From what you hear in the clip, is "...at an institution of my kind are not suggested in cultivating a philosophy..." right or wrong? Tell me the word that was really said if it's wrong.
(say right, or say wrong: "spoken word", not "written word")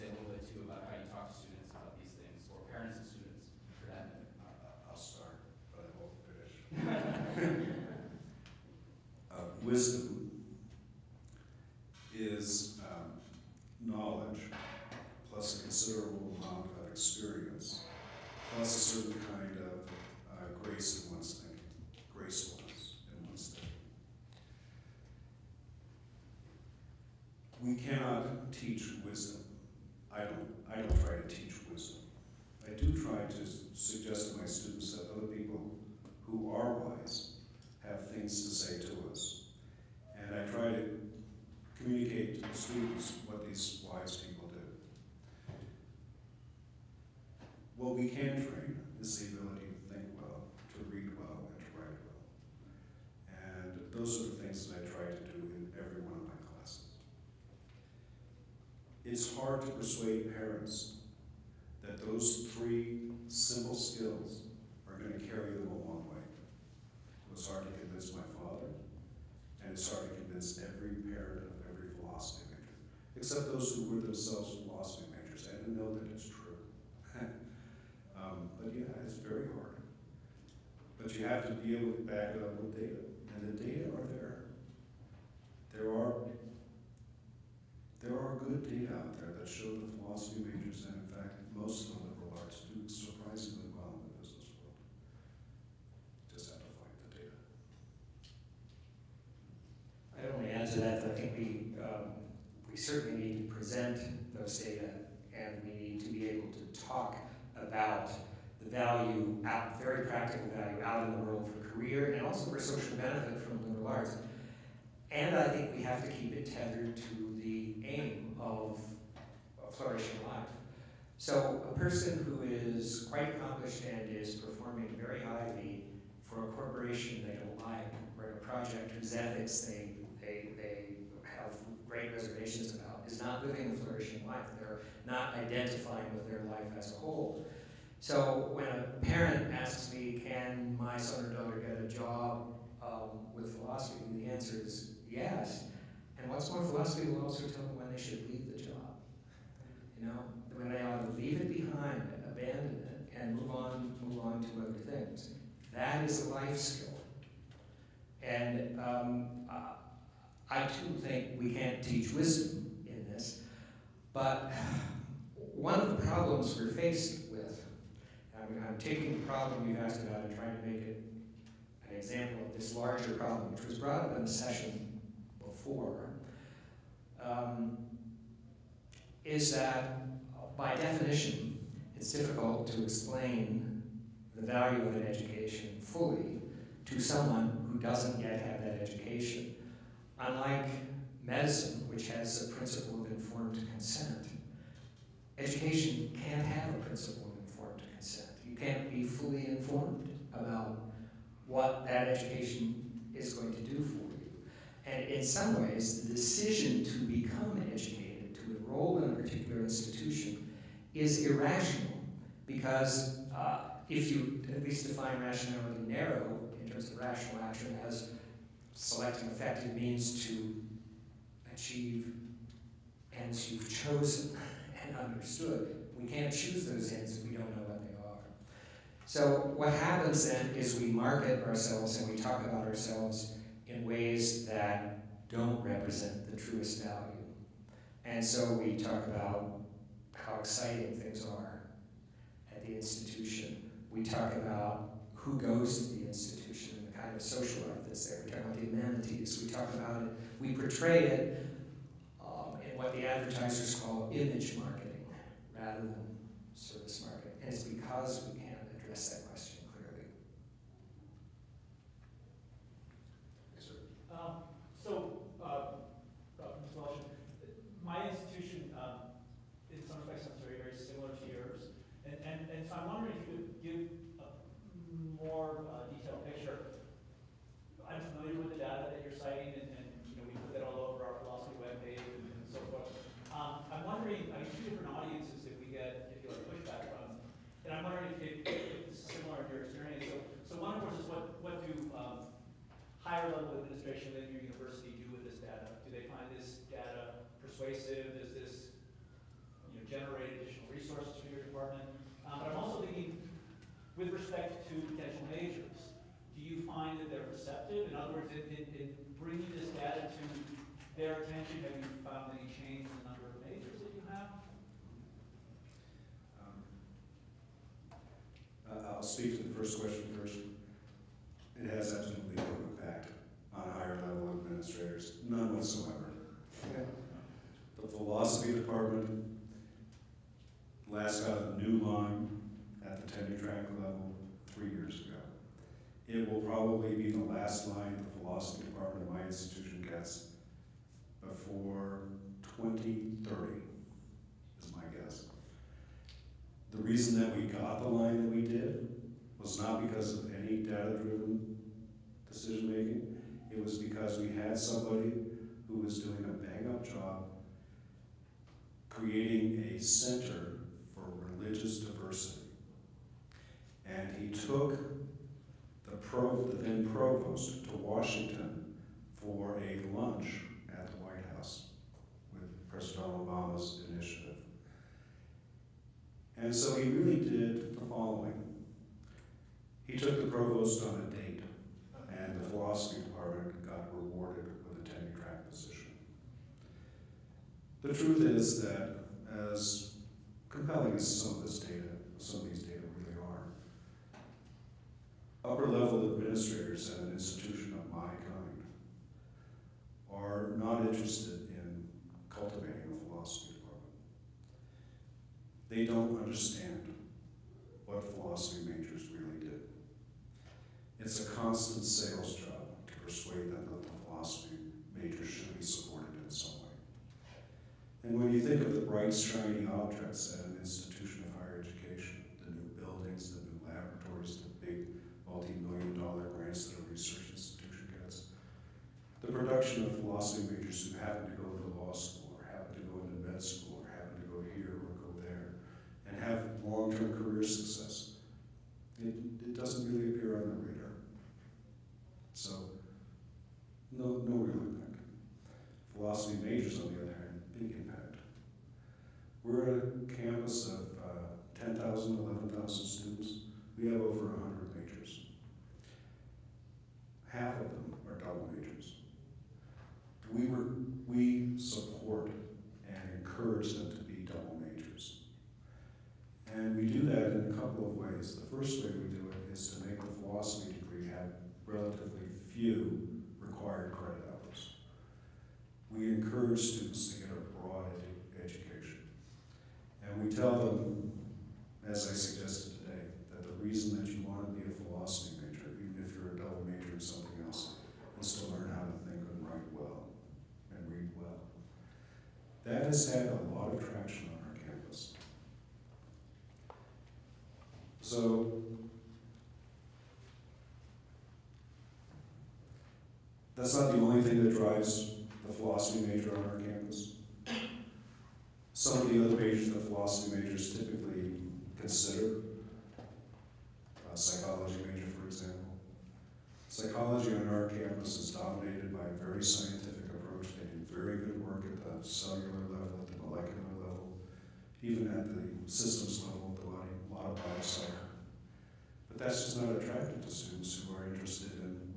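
wrong: "interested", not "suggested".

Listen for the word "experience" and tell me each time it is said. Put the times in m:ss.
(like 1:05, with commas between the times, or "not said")
0:16, 4:49.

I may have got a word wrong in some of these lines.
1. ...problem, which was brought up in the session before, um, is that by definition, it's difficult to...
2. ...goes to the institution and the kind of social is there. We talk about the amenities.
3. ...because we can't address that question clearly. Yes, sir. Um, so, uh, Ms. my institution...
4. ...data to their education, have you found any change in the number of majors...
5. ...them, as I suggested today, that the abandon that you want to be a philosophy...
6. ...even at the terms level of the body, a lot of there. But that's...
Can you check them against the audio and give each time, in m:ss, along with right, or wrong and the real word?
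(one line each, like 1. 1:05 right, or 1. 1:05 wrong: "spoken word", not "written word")
1. 2:53 right
2. 4:05 right
3. 4:17 right
4. 5:09 wrong: "attention", not "education"
5. 8:00 wrong: "reason", not "abandon"
6. 8:44 wrong: "systems", not "terms".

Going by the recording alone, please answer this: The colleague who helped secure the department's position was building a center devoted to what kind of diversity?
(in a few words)
religious diversity.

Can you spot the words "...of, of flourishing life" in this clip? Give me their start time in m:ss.
1:58.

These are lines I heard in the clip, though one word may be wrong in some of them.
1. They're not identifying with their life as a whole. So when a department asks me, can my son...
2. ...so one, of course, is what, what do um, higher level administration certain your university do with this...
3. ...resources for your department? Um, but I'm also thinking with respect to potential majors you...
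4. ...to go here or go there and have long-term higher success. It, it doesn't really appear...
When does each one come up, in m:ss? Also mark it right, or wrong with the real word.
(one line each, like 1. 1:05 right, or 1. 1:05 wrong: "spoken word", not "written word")
1. 2:14 wrong: "parent", not "department"
2. 4:50 wrong: "within", not "certain"
3. 5:00 right
4. 7:14 wrong: "career", not "higher".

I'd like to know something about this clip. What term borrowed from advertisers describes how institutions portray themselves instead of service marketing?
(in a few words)
image marketing.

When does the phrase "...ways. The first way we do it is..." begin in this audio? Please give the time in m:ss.
7:47.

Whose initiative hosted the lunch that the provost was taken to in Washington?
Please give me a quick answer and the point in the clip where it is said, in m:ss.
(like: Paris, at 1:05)
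President Obama, at 6:12.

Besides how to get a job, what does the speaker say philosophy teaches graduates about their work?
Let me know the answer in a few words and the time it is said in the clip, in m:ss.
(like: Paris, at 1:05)
when they should leave, at 2:27.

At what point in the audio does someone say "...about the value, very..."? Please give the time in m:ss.
1:47.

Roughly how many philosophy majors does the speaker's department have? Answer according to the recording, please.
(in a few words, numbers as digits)
over 100.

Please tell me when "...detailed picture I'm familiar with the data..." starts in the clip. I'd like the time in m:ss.
4:35.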